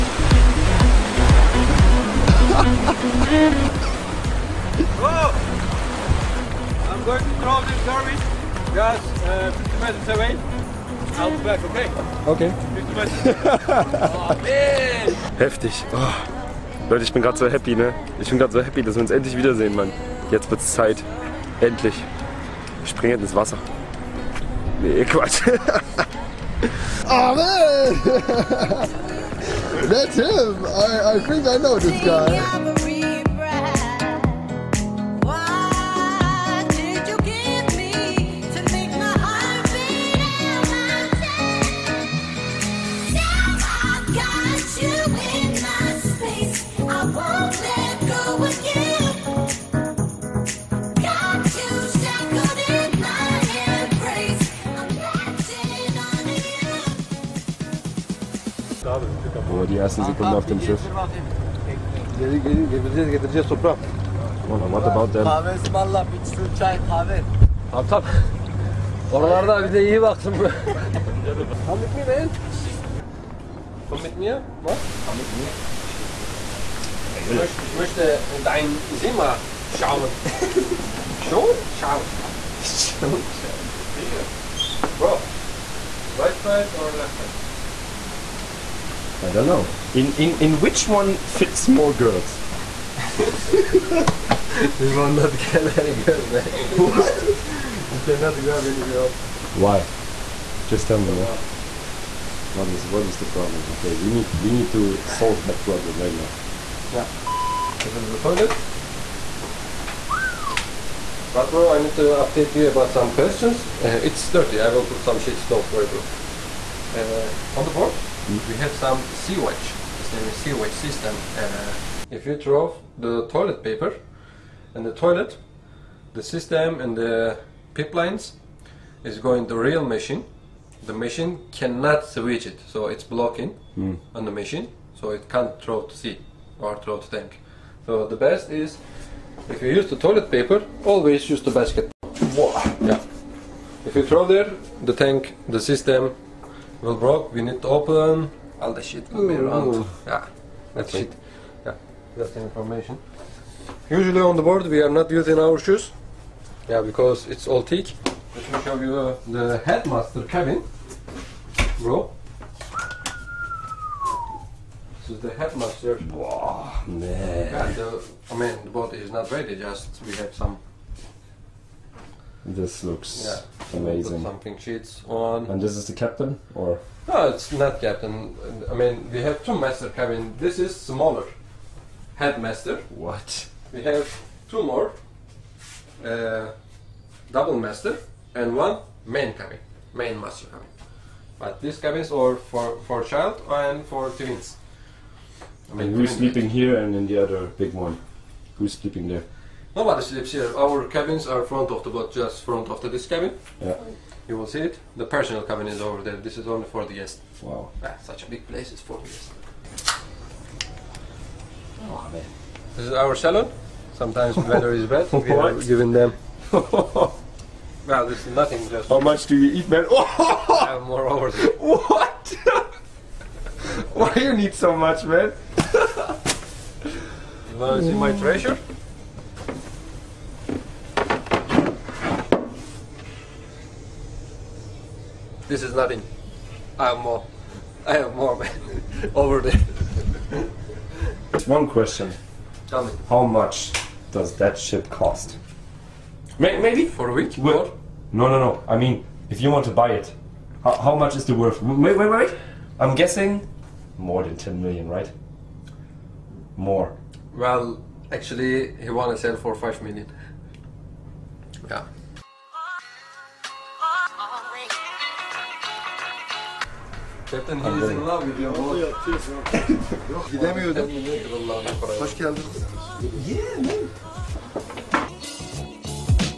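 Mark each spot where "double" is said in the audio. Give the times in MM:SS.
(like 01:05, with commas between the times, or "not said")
03:07.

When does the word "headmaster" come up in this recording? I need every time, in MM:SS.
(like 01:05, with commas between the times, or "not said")
02:39, 02:45, 03:02.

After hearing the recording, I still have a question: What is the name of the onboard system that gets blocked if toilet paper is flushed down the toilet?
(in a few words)
Sea Watch system.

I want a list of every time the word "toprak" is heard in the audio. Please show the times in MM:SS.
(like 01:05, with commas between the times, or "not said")
01:03.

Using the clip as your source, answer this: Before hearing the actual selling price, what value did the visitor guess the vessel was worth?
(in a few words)
More than 10 million.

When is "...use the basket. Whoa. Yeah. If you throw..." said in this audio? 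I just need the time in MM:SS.
02:21.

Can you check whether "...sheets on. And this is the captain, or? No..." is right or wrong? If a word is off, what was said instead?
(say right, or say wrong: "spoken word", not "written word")
right.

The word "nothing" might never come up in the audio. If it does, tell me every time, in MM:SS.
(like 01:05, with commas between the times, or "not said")
03:38, 03:55.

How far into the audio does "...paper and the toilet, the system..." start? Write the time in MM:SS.
02:03.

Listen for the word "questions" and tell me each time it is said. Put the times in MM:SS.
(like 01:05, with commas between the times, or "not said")
01:53, 04:01.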